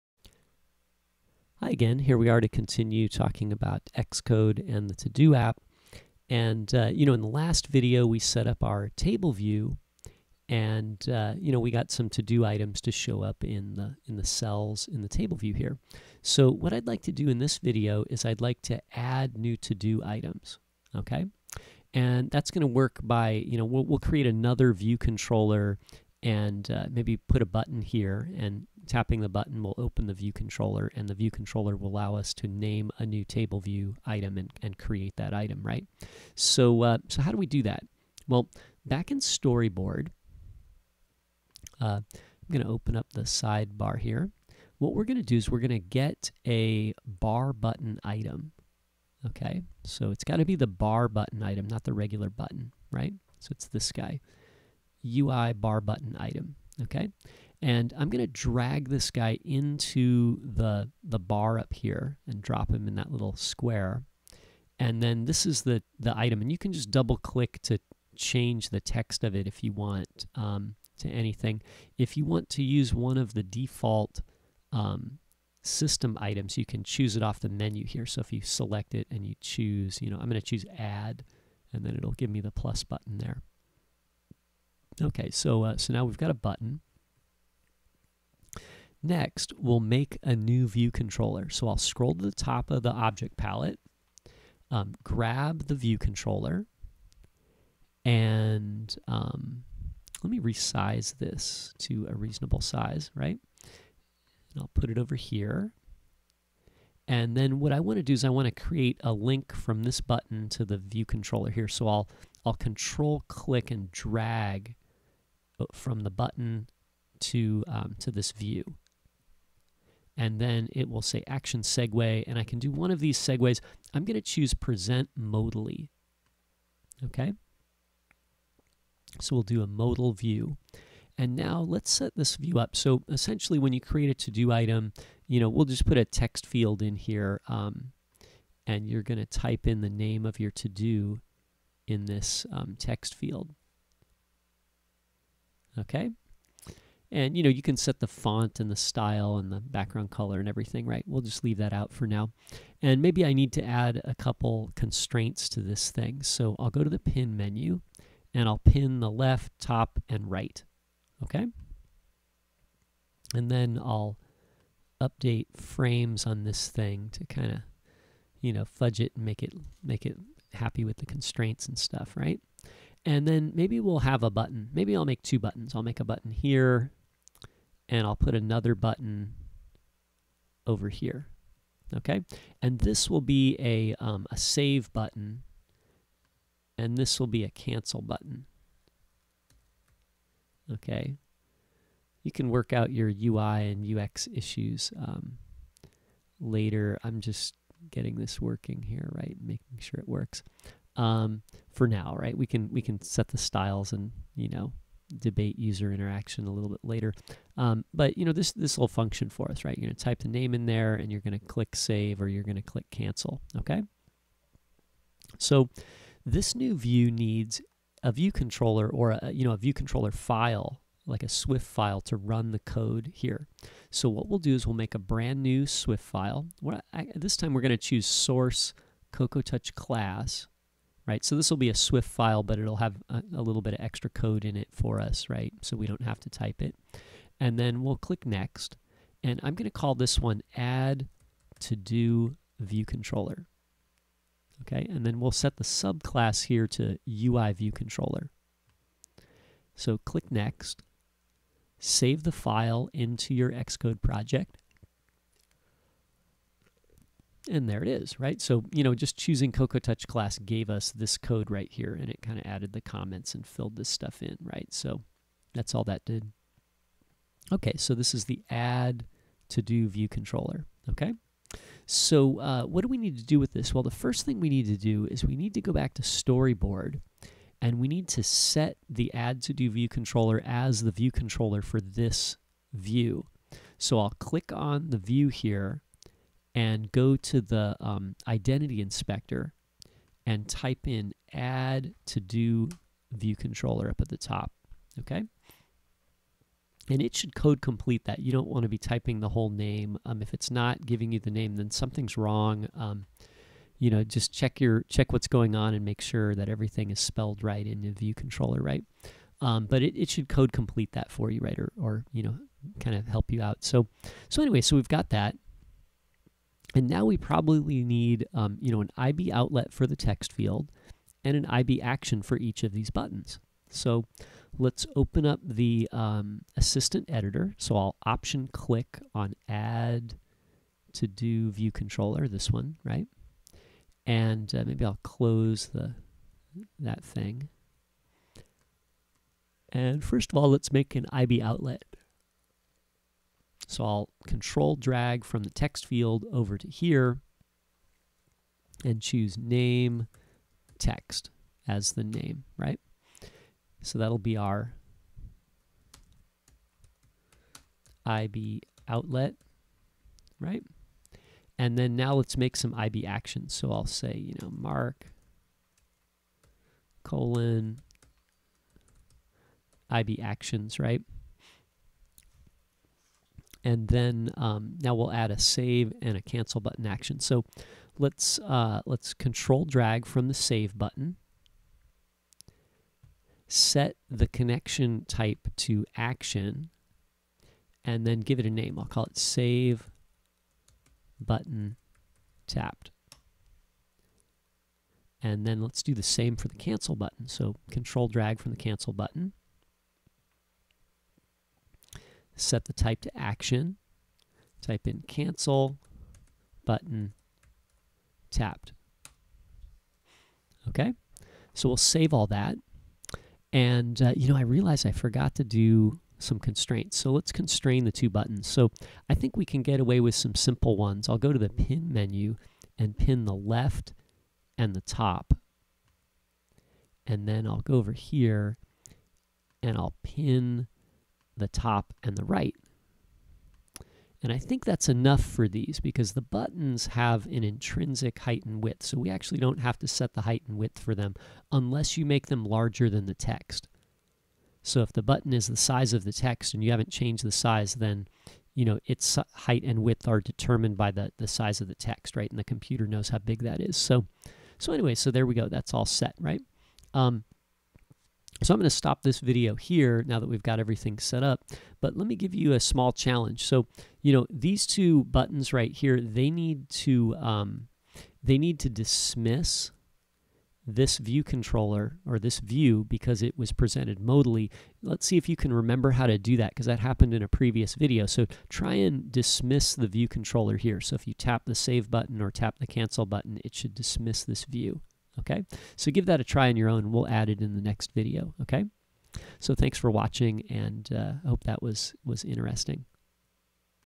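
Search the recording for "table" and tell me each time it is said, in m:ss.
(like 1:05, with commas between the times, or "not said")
0:08, 0:15, 0:33.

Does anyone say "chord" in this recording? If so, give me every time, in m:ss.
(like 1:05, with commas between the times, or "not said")
not said.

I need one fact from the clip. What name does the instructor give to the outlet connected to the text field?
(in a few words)
name text.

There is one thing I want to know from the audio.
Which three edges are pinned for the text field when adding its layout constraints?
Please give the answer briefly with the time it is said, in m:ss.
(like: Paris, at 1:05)
left, top, and right, at 2:39.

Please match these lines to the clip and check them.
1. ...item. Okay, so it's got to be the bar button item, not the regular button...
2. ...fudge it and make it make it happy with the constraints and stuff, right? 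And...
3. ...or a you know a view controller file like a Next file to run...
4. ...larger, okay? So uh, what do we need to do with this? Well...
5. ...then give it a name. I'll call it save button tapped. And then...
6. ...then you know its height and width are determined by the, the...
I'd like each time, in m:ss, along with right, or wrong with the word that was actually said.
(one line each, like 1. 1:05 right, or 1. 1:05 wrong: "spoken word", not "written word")
1. 0:48 right
2. 2:48 right
3. 3:38 wrong: "Swift", not "Next"
4. 4:30 wrong: "controller", not "larger"
5. 6:28 right
6. 7:27 right.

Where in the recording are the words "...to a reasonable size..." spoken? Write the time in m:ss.
1:41.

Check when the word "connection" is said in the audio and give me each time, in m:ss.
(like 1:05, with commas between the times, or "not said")
6:24.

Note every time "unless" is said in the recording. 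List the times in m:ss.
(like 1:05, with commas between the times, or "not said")
7:21.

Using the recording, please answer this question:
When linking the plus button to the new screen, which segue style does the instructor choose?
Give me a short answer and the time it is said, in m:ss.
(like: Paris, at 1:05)
present modally, at 2:04.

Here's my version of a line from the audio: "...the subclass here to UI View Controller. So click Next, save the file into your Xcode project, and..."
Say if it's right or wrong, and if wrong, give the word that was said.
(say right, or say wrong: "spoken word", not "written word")
right.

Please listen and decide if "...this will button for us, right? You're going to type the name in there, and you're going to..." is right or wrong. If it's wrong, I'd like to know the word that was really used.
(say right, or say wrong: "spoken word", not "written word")
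wrong: "function", not "button".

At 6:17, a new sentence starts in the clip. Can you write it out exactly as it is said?
So let's, uh, let's control drag from the save button.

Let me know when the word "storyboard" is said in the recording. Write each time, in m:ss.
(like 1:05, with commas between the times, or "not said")
0:39, 4:36.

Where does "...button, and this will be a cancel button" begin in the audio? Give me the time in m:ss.
3:04.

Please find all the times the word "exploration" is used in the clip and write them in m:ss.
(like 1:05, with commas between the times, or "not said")
not said.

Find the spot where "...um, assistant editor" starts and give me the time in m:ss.
5:25.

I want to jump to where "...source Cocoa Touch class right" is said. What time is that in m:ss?
3:48.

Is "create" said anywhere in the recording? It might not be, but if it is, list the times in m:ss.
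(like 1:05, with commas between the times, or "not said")
0:23, 0:34, 1:48, 2:13.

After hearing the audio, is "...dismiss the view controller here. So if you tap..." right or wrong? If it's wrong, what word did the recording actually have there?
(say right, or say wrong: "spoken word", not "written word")
right.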